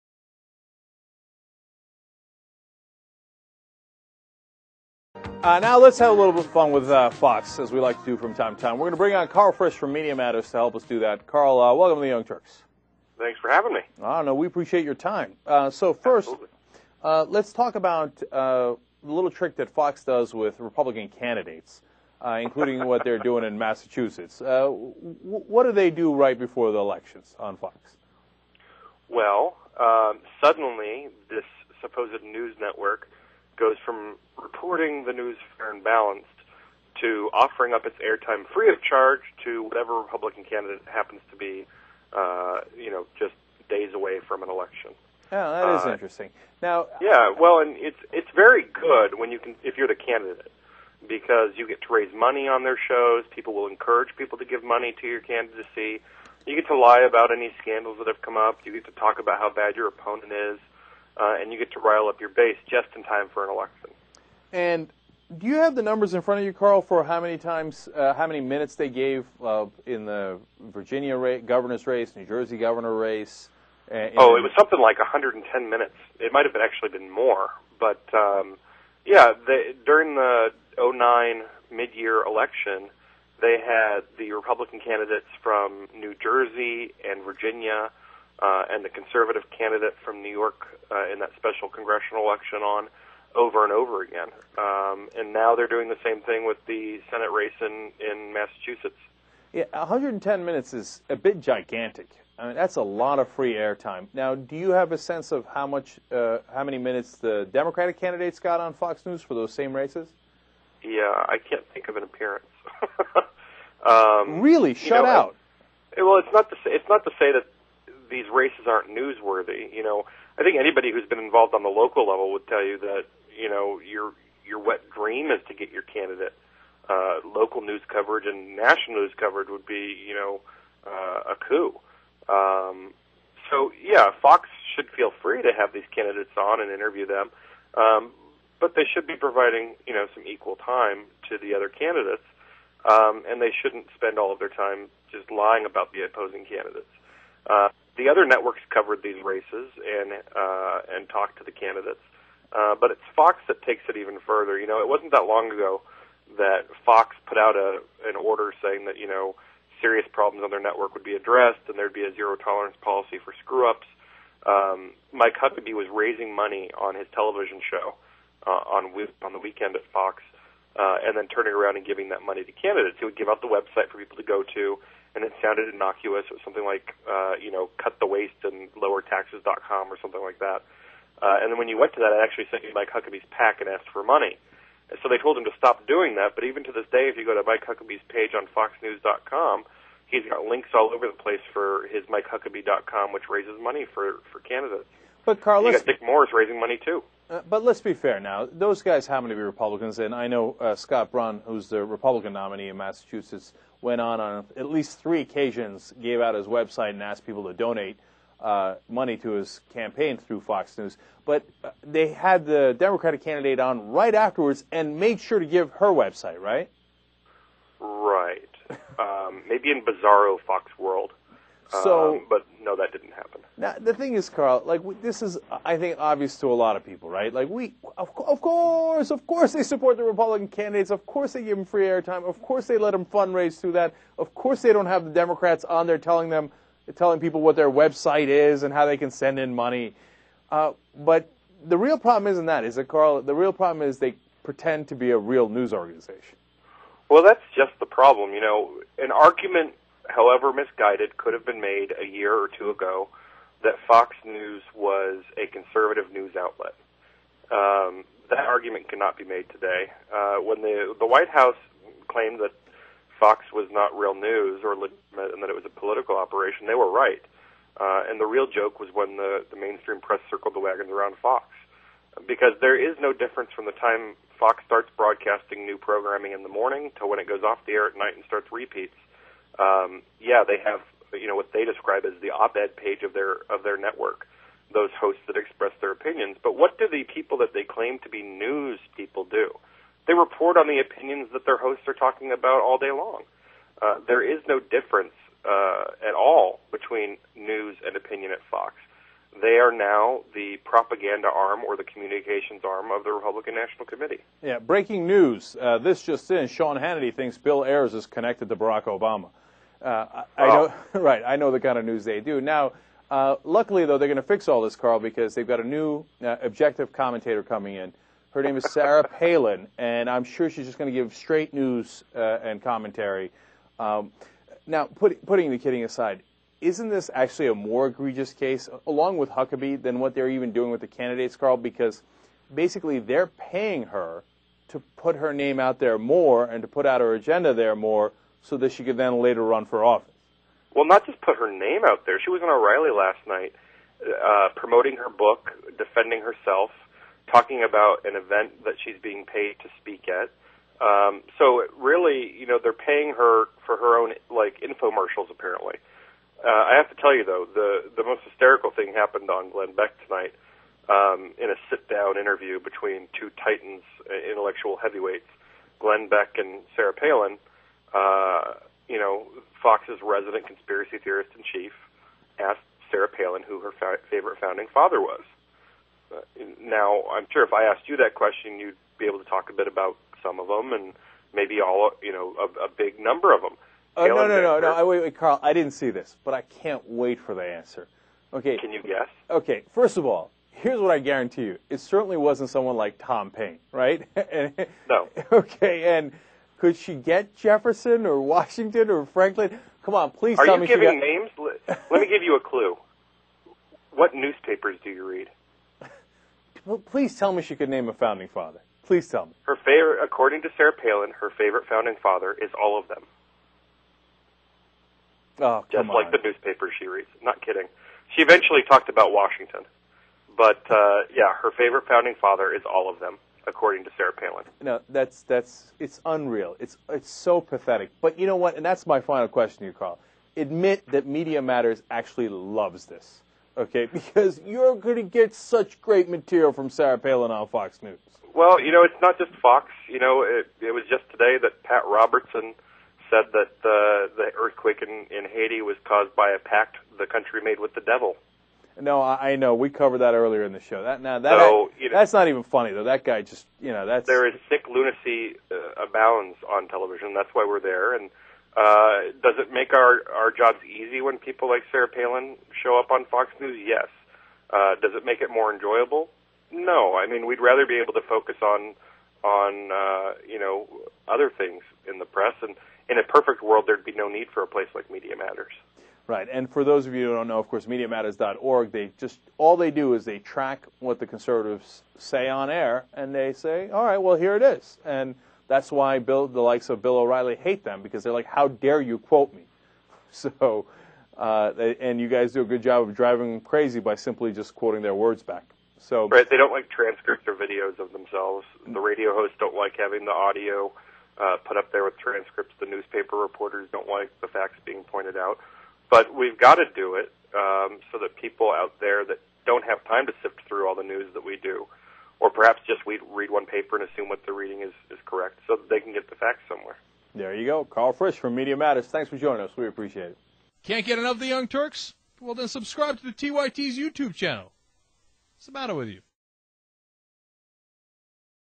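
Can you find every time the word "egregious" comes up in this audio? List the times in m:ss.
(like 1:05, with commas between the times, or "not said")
5:27.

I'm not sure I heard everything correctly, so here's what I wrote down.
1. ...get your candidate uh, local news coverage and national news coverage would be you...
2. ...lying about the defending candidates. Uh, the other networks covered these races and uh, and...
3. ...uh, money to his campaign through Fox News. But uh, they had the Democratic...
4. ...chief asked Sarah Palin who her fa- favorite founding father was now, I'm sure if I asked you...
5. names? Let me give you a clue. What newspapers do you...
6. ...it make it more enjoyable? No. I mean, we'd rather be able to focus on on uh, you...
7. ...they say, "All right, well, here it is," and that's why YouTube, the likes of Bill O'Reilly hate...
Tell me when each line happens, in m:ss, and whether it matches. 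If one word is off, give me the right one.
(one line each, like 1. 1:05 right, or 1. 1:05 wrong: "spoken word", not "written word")
1. 2:05 right
2. 2:25 wrong: "opposing", not "defending"
3. 3:28 right
4. 6:11 right
5. 6:41 right
6. 7:44 right
7. 8:03 wrong: "Bill", not "YouTube".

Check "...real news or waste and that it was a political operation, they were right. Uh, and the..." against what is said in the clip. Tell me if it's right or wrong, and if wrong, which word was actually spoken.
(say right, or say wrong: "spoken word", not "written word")
wrong: "legitimate", not "waste".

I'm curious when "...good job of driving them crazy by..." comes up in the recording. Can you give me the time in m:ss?
8:12.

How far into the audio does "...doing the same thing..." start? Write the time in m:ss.
1:35.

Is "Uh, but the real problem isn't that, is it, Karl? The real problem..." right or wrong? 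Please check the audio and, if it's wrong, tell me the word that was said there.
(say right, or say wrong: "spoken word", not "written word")
right.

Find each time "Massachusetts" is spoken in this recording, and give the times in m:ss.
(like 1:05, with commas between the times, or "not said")
0:23, 1:38, 3:22.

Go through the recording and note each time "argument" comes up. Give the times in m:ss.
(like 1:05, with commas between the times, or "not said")
4:09, 4:18.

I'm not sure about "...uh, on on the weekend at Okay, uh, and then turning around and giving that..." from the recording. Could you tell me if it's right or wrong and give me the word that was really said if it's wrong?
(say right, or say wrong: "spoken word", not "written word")
wrong: "Fox", not "Okay".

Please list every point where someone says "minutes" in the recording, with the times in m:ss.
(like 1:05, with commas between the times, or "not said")
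1:08, 1:15, 1:40, 1:46.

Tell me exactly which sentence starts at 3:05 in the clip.
so they told him to stop doing that.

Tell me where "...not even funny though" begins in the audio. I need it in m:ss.
7:32.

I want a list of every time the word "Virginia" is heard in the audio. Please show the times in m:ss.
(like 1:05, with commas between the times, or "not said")
1:10, 1:27.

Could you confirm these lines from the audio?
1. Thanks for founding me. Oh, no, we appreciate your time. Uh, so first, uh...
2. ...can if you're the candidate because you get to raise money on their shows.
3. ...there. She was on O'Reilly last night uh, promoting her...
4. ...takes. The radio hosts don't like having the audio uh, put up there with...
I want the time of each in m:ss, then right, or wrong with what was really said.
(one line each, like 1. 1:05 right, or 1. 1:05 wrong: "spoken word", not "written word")
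1. 0:13 wrong: "having", not "founding"
2. 0:49 right
3. 5:42 right
4. 8:17 wrong: "themselves", not "takes".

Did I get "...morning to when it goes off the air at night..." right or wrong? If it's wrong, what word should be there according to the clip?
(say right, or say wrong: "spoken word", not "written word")
right.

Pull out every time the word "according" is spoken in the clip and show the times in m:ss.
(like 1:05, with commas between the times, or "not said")
6:50, 7:03.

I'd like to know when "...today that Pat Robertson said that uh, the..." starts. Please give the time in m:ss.
7:21.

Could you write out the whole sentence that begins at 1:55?
It, well, it's not to say, it's not to say that these races aren't newsworthy.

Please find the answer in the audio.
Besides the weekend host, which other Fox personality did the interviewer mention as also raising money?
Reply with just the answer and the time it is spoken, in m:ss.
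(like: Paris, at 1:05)
Dick Morris, at 3:15.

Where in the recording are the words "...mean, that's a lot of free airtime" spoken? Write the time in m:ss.
1:42.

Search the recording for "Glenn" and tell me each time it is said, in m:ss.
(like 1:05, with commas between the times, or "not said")
5:59, 6:05.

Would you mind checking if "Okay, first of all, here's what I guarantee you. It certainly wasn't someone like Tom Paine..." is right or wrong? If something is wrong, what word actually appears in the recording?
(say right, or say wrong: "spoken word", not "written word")
right.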